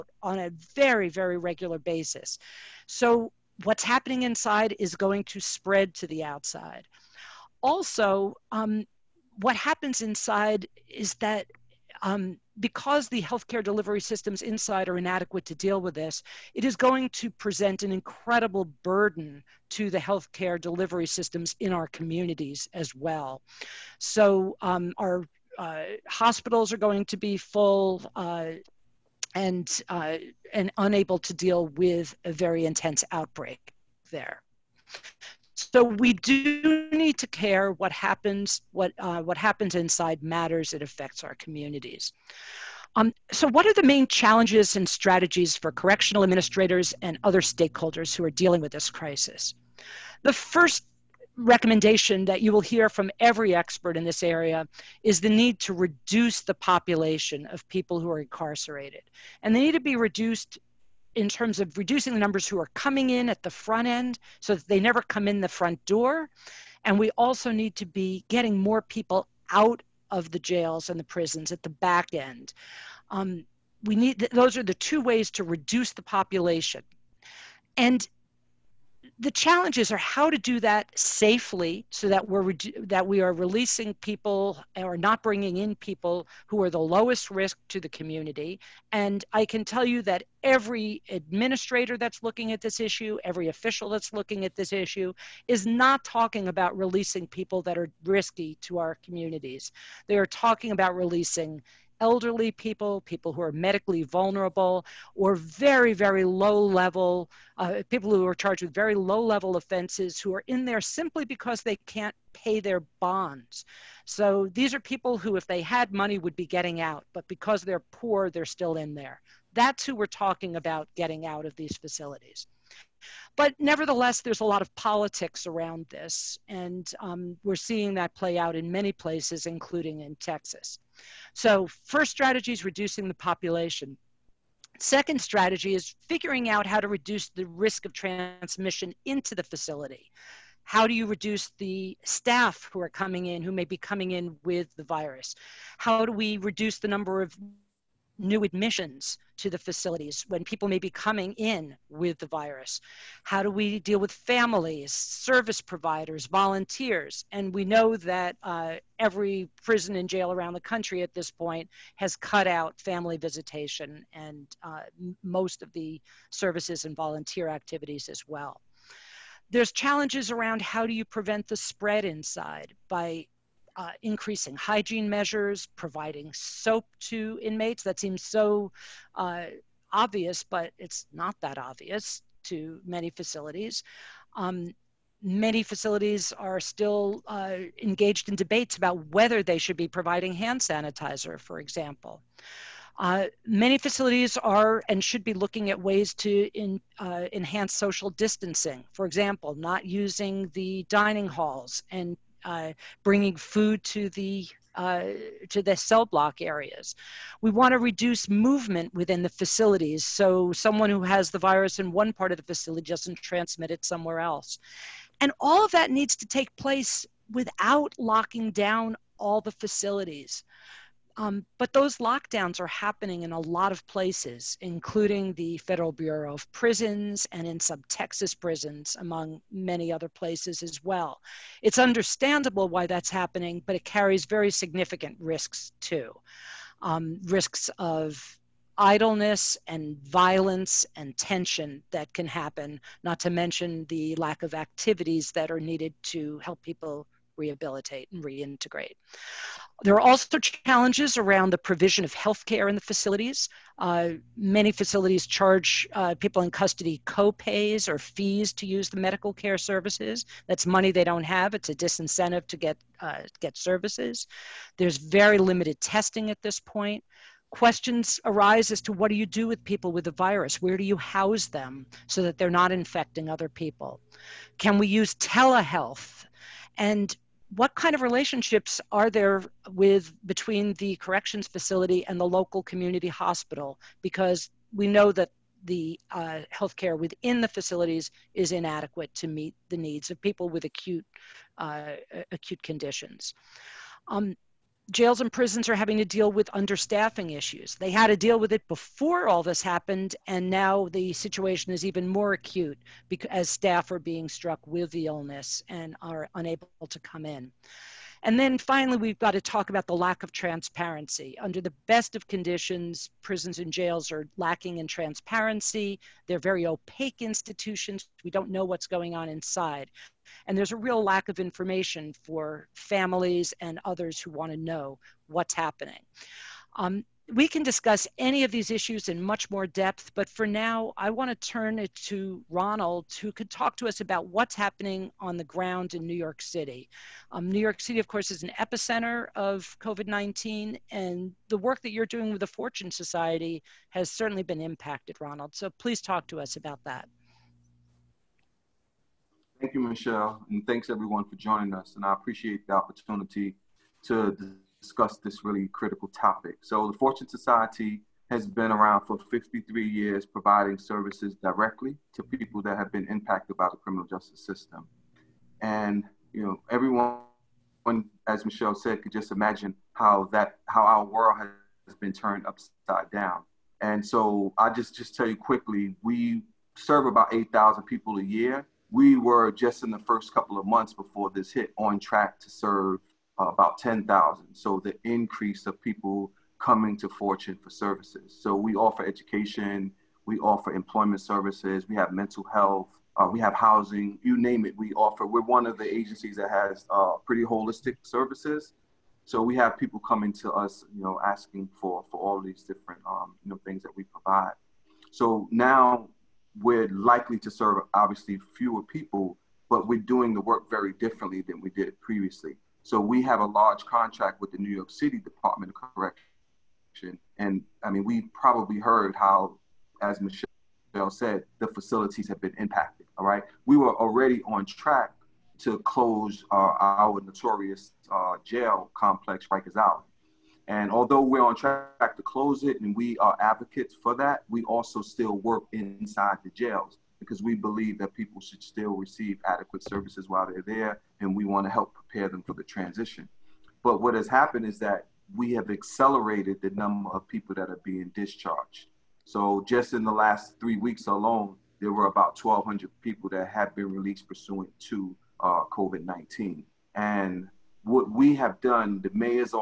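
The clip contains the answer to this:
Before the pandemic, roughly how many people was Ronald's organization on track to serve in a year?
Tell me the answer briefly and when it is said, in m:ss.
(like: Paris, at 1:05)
10,000, at 6:23.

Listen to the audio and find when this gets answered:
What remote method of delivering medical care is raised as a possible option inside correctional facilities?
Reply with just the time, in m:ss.
4:35.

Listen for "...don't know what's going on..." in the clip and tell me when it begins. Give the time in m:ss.
5:18.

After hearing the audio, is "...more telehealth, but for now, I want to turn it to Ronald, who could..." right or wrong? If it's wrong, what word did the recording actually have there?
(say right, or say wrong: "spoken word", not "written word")
wrong: "depth", not "telehealth".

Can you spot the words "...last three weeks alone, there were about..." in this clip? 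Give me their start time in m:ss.
7:30.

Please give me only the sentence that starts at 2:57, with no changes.
That seems so uh, obvious, but it's not that obvious to many facilities.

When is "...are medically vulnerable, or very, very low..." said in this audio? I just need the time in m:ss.
1:43.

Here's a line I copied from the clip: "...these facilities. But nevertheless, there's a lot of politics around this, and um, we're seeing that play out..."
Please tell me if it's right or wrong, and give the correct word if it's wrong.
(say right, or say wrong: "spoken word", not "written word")
right.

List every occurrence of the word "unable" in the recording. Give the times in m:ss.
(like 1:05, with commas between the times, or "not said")
0:30, 5:06.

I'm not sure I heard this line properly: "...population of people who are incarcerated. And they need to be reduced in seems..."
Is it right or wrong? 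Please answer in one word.
wrong.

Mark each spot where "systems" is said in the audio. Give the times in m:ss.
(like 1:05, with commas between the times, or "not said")
0:14, 0:21, 6:04.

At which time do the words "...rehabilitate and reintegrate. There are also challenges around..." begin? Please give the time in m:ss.
4:07.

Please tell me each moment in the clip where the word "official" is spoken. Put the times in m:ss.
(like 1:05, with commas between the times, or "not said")
1:33.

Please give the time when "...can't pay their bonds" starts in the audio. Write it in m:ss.
1:51.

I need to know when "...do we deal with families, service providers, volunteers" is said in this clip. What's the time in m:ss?
2:33.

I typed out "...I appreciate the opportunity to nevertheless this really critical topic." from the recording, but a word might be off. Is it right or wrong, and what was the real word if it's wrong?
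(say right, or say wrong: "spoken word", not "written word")
wrong: "discuss", not "nevertheless".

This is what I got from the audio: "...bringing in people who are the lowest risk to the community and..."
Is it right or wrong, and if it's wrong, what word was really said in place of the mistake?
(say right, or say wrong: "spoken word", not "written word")
right.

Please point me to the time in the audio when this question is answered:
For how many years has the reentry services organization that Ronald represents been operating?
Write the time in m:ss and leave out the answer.
5:59.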